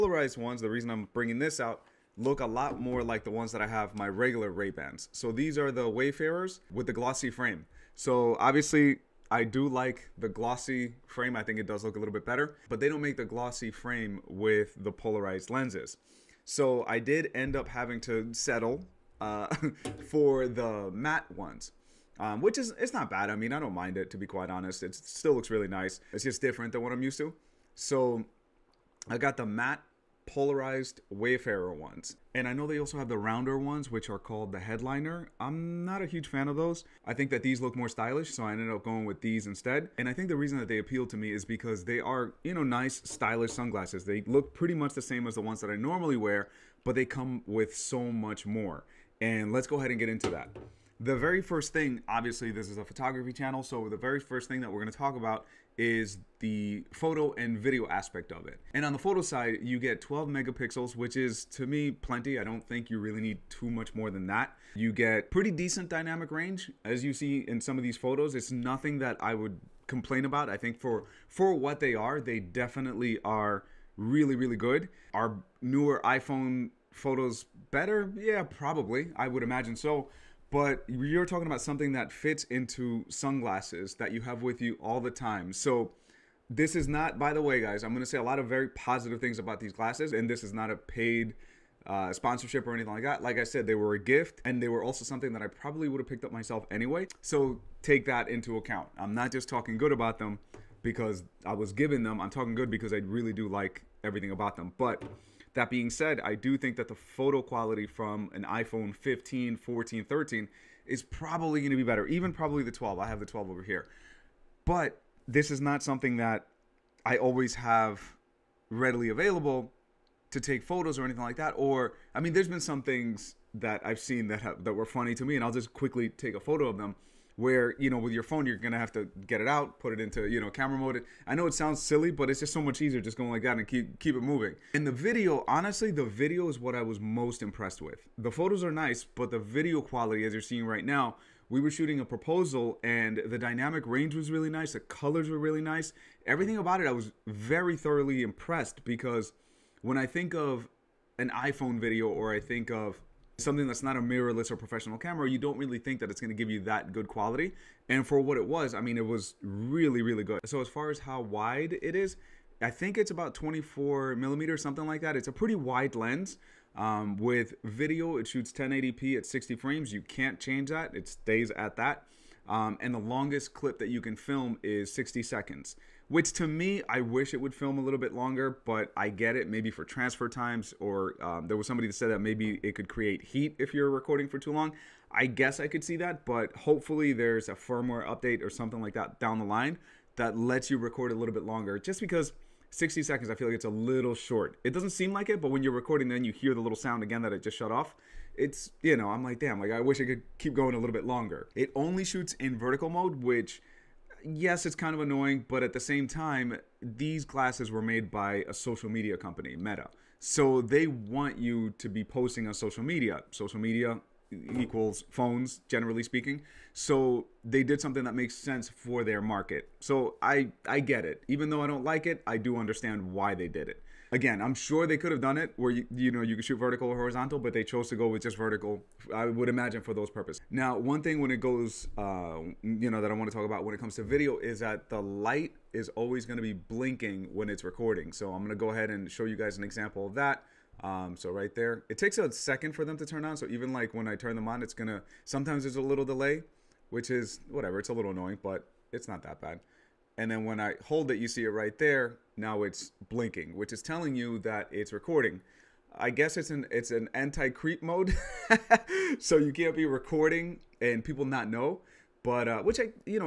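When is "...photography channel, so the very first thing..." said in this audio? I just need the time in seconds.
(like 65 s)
52 s.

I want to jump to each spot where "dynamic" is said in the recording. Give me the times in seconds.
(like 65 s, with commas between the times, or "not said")
65 s, 143 s.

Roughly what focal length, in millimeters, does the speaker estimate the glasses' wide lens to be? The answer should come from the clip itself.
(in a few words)
24 millimeters.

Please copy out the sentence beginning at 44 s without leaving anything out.
They look pretty much the same as the ones that I normally wear, but they come with so much more.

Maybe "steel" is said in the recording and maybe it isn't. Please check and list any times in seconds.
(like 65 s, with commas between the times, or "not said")
not said.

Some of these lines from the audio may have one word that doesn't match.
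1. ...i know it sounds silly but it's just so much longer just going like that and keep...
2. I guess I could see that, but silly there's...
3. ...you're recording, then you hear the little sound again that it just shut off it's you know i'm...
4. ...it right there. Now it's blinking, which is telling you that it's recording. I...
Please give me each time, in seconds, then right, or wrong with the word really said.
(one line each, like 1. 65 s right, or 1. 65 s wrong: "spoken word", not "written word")
1. 131 s wrong: "easier", not "longer"
2. 185 s wrong: "hopefully", not "silly"
3. 195 s right
4. 251 s right.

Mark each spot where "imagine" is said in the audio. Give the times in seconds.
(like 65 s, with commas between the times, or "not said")
79 s, 229 s.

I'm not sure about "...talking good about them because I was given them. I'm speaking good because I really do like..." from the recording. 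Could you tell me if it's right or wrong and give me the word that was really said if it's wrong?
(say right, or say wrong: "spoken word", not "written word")
wrong: "talking", not "speaking".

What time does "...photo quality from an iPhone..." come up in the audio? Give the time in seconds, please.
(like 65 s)
106 s.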